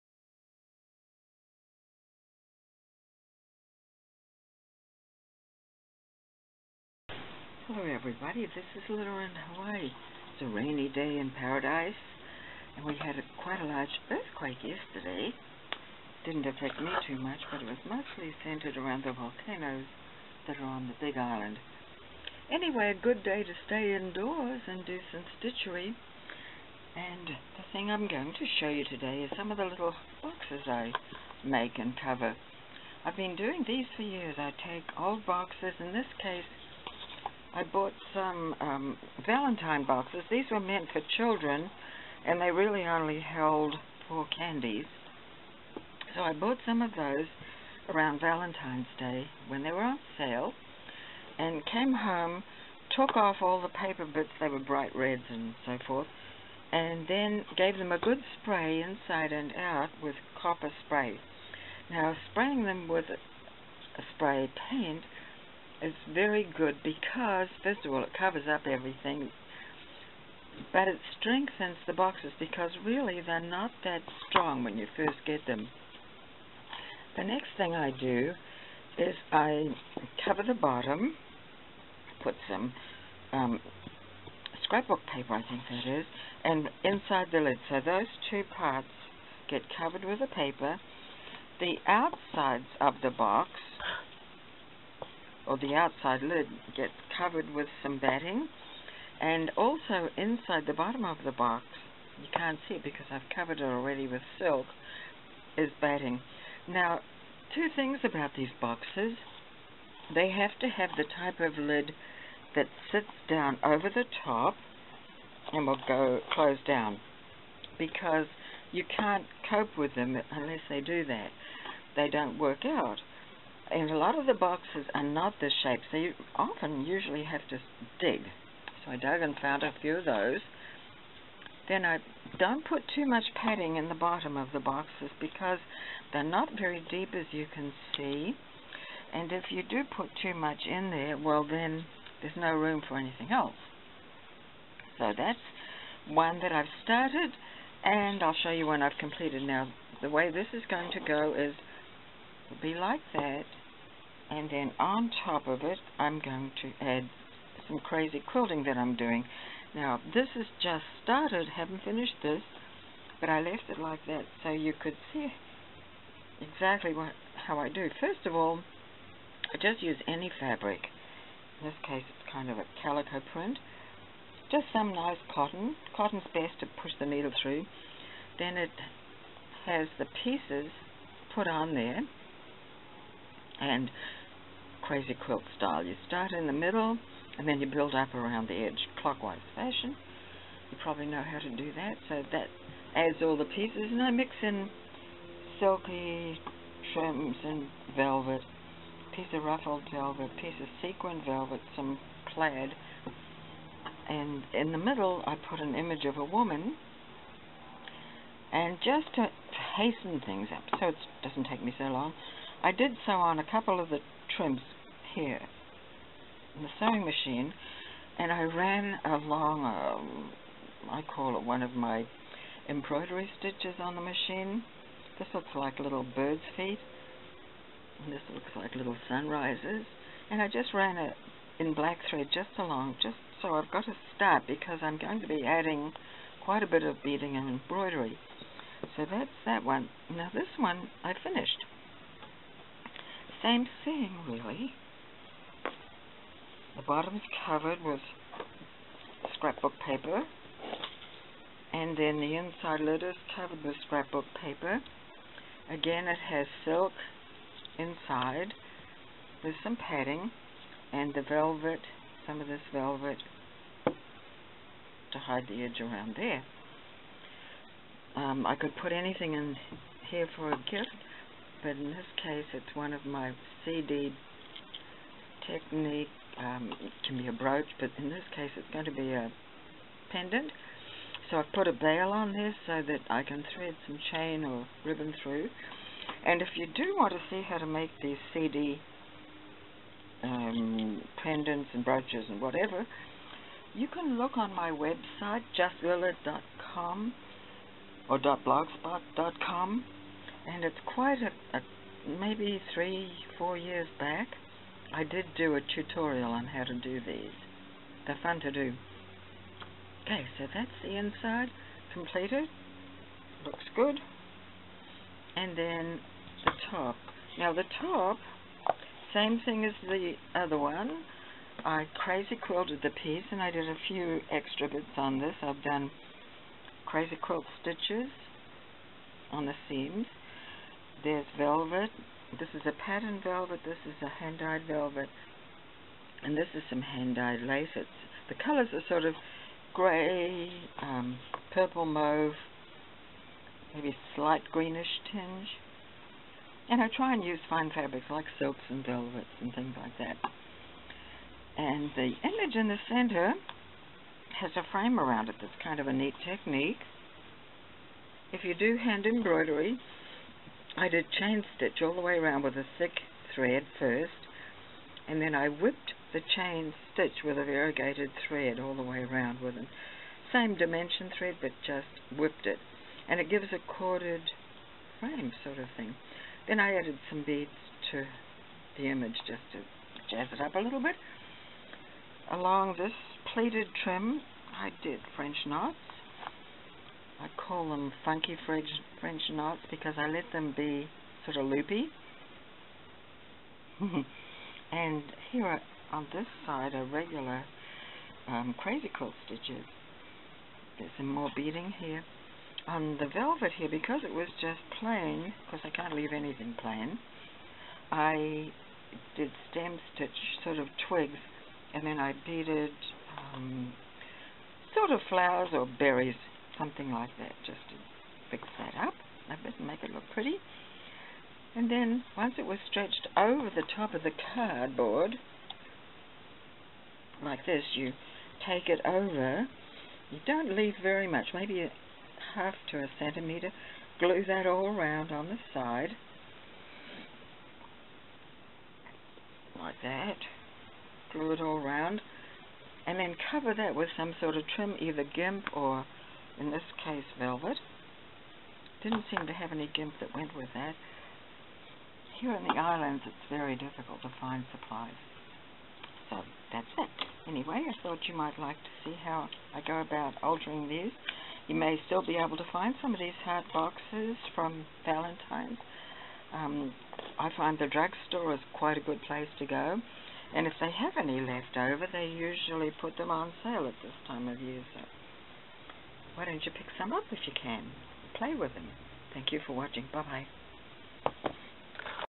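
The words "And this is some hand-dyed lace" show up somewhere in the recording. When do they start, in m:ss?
5:36.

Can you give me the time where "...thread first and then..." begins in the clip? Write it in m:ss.
6:03.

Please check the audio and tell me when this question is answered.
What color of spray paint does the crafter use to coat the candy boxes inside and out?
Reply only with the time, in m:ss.
1:00.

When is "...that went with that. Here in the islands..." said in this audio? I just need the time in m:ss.
7:29.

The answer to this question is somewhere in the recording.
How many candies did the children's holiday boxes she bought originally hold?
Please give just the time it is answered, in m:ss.
0:44.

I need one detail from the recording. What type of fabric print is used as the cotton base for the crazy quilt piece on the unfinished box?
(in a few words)
Calico.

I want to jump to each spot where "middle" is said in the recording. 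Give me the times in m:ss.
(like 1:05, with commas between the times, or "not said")
3:06, 3:24.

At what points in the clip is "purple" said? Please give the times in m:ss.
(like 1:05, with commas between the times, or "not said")
5:41.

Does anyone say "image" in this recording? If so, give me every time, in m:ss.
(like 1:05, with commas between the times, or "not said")
3:25, 5:52, 6:18.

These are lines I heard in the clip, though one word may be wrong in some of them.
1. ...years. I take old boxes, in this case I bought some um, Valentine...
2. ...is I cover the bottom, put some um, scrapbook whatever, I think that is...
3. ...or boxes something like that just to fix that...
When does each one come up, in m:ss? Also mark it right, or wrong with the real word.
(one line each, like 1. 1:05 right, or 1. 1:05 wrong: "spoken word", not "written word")
1. 0:34 right
2. 1:18 wrong: "paper", not "whatever"
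3. 6:55 wrong: "berries", not "boxes".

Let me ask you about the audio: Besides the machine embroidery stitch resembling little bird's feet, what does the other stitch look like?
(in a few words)
Little sunrises.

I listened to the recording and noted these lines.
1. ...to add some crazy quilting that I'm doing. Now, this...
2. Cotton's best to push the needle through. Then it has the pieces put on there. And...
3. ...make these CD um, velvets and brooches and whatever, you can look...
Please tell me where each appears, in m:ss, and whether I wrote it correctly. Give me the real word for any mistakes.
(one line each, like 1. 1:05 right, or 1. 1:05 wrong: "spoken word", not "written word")
1. 2:36 right
2. 2:55 right
3. 4:47 wrong: "pendants", not "velvets".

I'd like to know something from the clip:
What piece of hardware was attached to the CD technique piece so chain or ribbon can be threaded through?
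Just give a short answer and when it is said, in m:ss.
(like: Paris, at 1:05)
A bail, at 4:41.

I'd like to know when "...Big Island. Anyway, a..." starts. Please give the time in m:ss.
0:20.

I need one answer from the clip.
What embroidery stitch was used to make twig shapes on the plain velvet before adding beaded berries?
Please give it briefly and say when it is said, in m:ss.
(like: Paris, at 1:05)
Stem stitch, at 6:49.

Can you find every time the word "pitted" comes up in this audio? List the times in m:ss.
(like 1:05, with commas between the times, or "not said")
not said.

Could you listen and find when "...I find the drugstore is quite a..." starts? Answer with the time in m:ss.
7:47.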